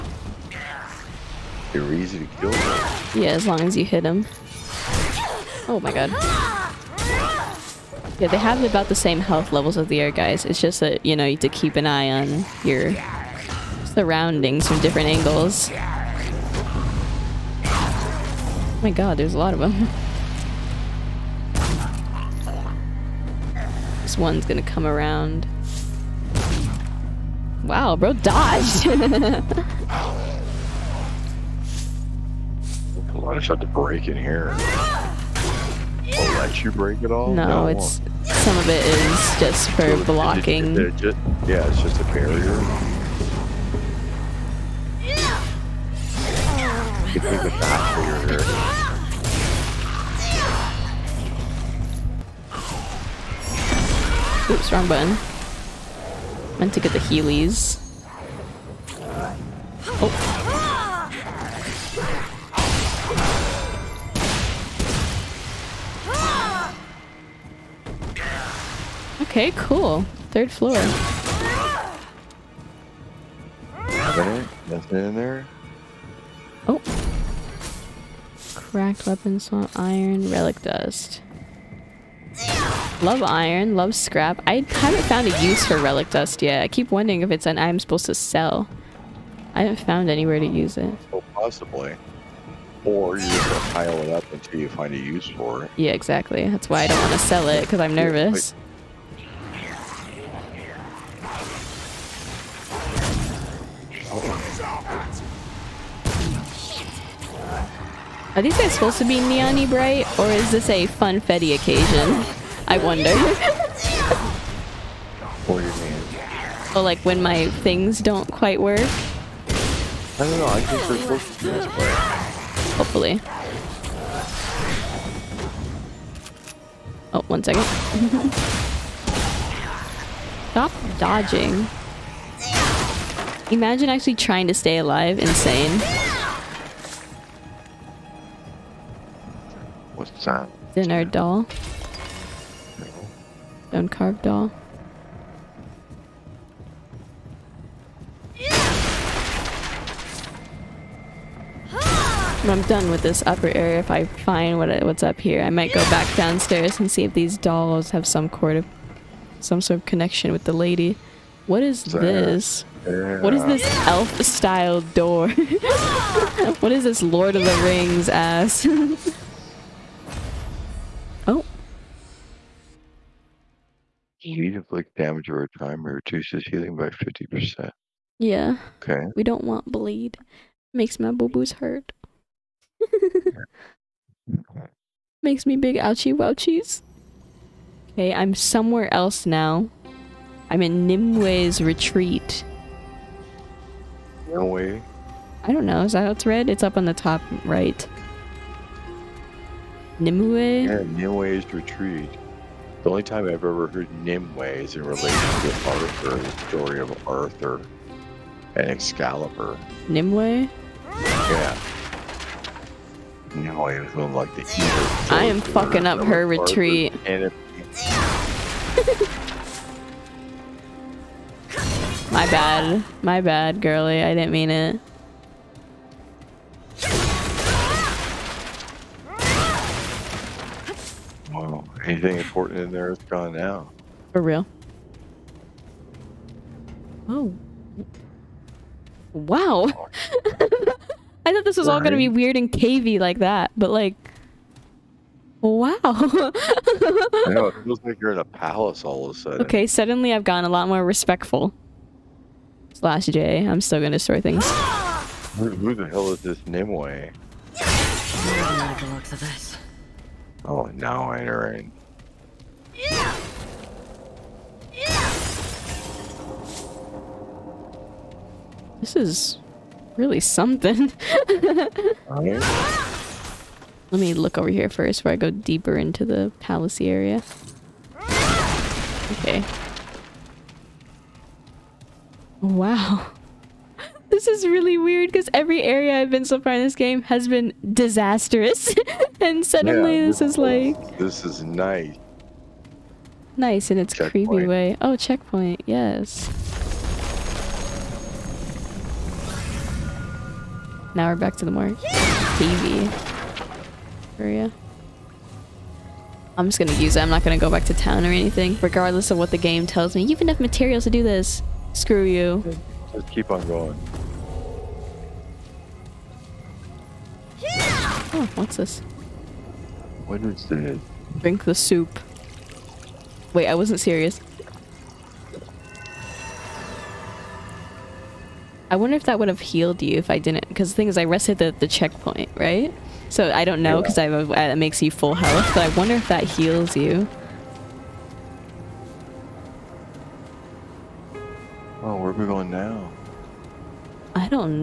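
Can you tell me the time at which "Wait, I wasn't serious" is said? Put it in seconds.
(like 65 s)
323 s.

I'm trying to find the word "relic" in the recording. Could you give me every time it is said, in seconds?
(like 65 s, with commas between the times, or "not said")
80 s, 85 s.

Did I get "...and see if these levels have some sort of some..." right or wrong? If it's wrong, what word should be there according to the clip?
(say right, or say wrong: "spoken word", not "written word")
wrong: "dolls", not "levels".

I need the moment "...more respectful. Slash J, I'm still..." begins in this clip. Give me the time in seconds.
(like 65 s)
250 s.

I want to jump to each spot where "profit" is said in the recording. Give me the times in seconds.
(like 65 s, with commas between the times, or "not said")
not said.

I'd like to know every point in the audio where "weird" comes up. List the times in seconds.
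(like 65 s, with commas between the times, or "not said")
242 s, 284 s.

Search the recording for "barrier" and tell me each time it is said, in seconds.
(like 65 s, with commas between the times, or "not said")
42 s, 47 s.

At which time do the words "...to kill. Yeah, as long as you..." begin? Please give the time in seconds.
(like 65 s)
2 s.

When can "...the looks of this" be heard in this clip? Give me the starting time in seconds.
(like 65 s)
258 s.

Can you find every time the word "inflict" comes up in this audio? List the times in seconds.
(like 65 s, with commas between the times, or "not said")
174 s.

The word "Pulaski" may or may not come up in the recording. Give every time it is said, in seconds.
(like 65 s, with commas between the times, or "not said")
not said.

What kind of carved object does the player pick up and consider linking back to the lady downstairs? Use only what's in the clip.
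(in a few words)
stone carved doll.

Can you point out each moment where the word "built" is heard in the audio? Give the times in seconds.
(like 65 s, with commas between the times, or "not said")
not said.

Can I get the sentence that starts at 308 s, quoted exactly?
Regardless of what the game tells me.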